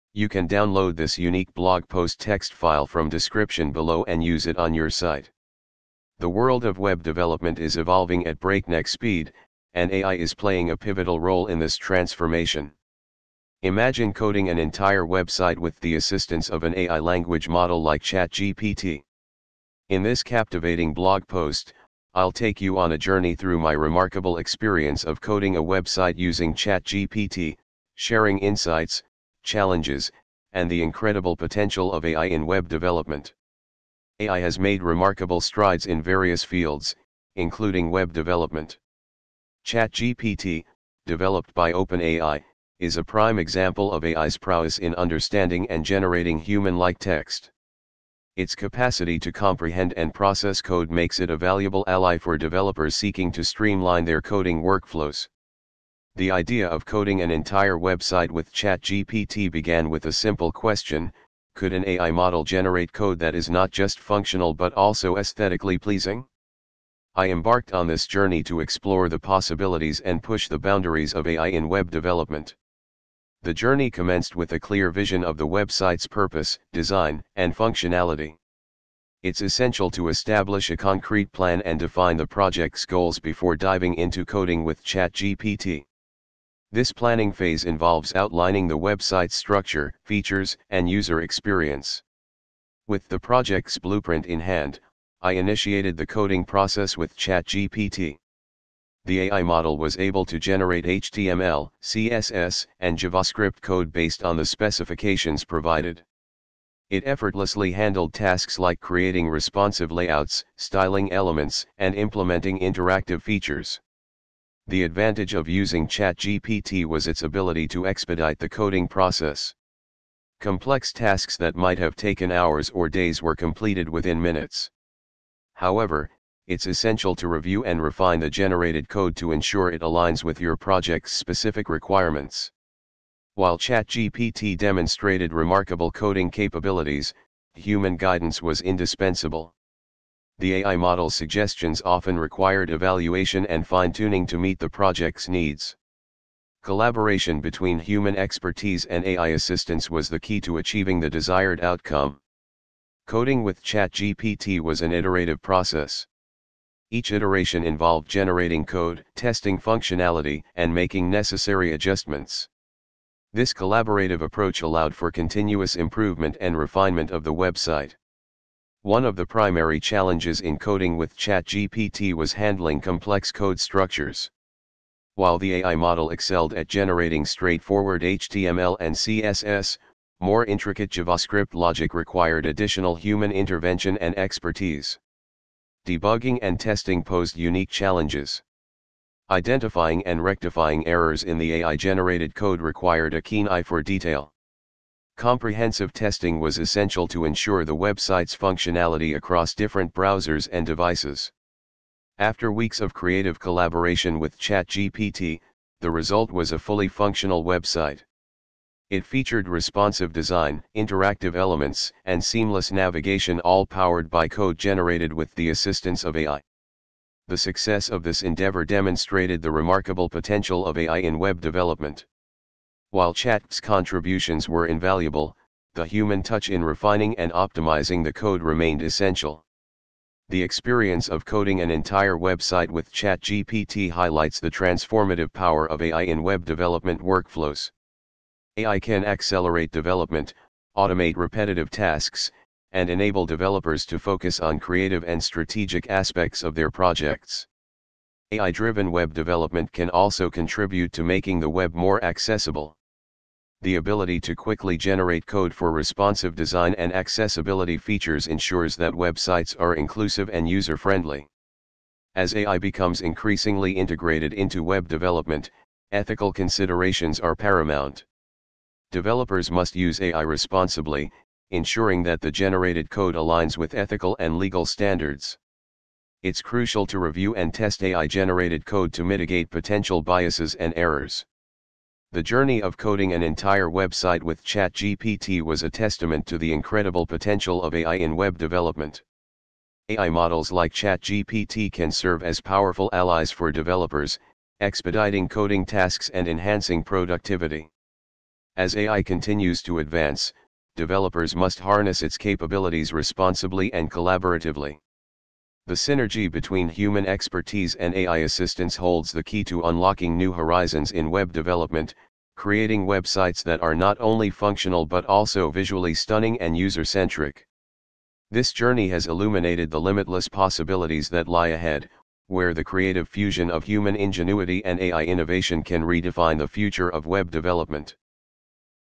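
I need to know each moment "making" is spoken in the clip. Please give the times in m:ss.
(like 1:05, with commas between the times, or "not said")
2:40, 4:11.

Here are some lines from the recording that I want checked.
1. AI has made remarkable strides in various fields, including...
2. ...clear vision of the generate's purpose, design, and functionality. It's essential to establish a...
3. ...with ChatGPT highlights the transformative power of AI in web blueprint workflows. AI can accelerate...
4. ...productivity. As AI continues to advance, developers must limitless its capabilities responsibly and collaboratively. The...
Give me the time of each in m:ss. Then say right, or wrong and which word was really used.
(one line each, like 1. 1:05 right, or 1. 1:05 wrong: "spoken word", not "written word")
1. 0:34 right
2. 1:14 wrong: "website", not "generate"
3. 3:52 wrong: "development", not "blueprint"
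4. 4:56 wrong: "harness", not "limitless".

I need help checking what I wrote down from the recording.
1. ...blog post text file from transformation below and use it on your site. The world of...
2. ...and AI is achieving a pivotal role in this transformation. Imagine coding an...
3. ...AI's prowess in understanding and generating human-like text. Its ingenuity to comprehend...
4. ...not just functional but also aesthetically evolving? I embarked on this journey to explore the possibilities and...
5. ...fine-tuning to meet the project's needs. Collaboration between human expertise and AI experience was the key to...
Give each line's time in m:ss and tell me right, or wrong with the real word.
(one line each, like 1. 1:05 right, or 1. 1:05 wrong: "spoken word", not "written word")
1. 0:01 wrong: "description", not "transformation"
2. 0:09 wrong: "playing", not "achieving"
3. 0:44 wrong: "capacity", not "ingenuity"
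4. 1:03 wrong: "pleasing", not "evolving"
5. 2:23 wrong: "assistance", not "experience".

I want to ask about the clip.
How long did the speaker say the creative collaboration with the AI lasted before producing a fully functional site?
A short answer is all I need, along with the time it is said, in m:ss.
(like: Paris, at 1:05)
Weeks, at 3:22.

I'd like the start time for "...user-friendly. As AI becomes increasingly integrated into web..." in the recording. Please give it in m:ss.
4:20.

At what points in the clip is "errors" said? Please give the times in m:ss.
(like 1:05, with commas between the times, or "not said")
3:10, 4:40.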